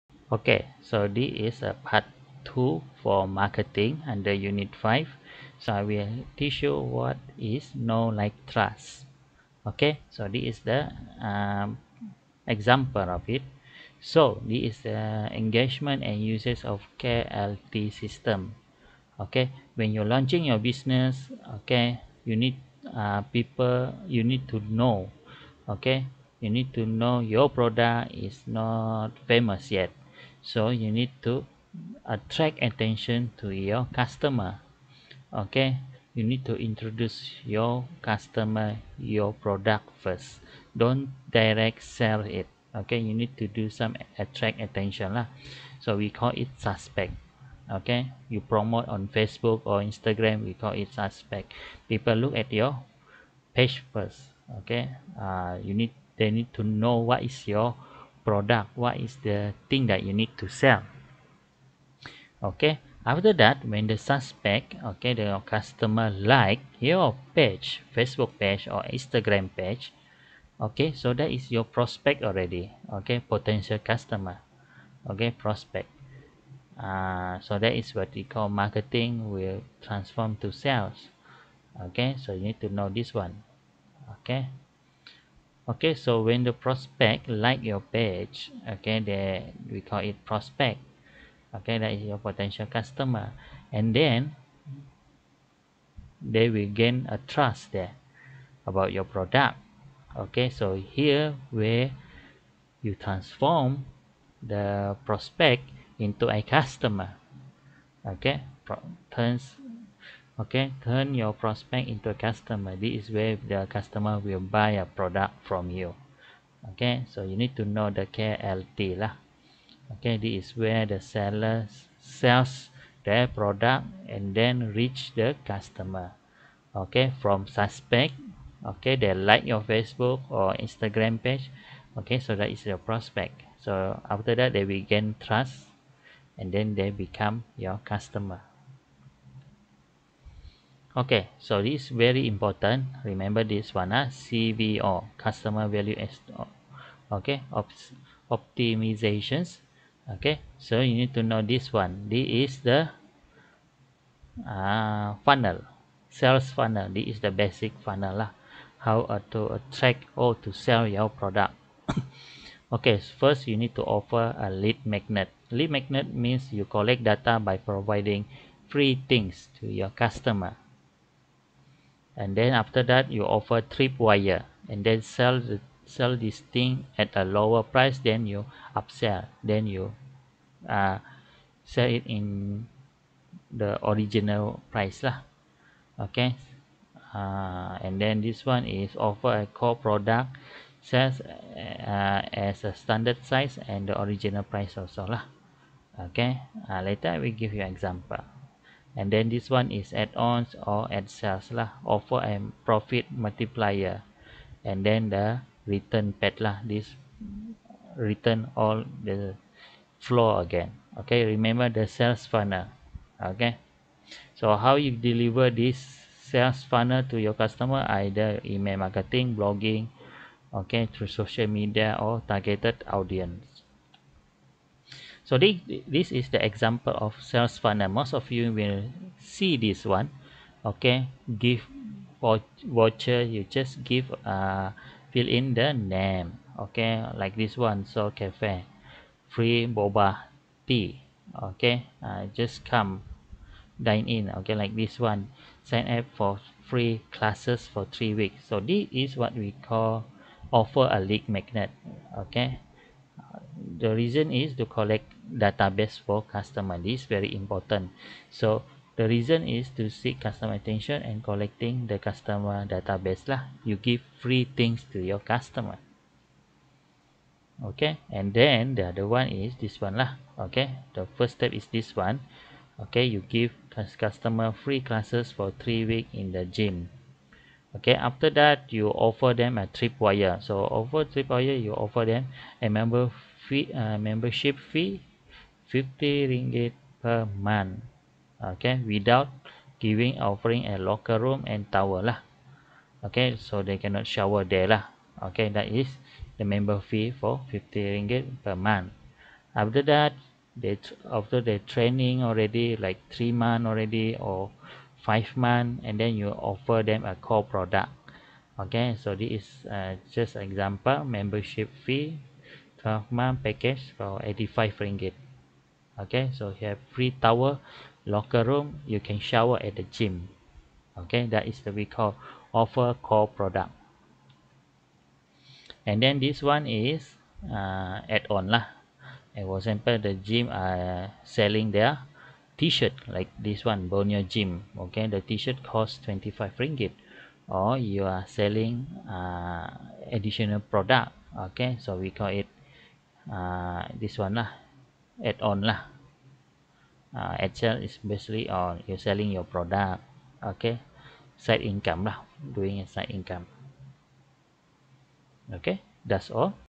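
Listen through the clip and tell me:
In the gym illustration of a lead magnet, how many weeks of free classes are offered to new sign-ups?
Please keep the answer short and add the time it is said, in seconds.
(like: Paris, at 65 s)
3, at 247 s.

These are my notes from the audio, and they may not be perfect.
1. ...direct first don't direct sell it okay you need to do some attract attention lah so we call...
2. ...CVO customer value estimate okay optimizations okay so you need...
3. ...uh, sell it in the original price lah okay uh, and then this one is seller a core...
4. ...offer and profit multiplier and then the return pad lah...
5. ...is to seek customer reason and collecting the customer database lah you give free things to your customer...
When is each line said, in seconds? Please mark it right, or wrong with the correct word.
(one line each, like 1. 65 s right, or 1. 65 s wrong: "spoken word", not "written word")
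1. 39 s wrong: "product", not "direct"
2. 144 s right
3. 180 s wrong: "offer", not "seller"
4. 201 s right
5. 259 s wrong: "attention", not "reason".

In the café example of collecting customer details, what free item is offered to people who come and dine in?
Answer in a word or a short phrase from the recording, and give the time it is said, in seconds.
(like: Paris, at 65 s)
boba tea, at 239 s.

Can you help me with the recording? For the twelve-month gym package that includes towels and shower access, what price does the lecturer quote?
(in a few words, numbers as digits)
85 ringgit.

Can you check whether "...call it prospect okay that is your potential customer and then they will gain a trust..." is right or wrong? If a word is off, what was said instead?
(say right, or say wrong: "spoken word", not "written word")
right.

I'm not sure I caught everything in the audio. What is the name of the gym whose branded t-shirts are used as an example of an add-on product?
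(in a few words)
Borneo Gym.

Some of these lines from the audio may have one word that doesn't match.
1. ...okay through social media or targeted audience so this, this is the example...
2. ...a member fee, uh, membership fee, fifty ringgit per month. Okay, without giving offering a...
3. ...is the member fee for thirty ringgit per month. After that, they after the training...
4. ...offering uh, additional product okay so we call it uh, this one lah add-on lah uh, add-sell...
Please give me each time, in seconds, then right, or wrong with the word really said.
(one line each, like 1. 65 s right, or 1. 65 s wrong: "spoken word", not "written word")
1. 220 s right
2. 282 s right
3. 295 s wrong: "fifty", not "thirty"
4. 338 s wrong: "selling", not "offering".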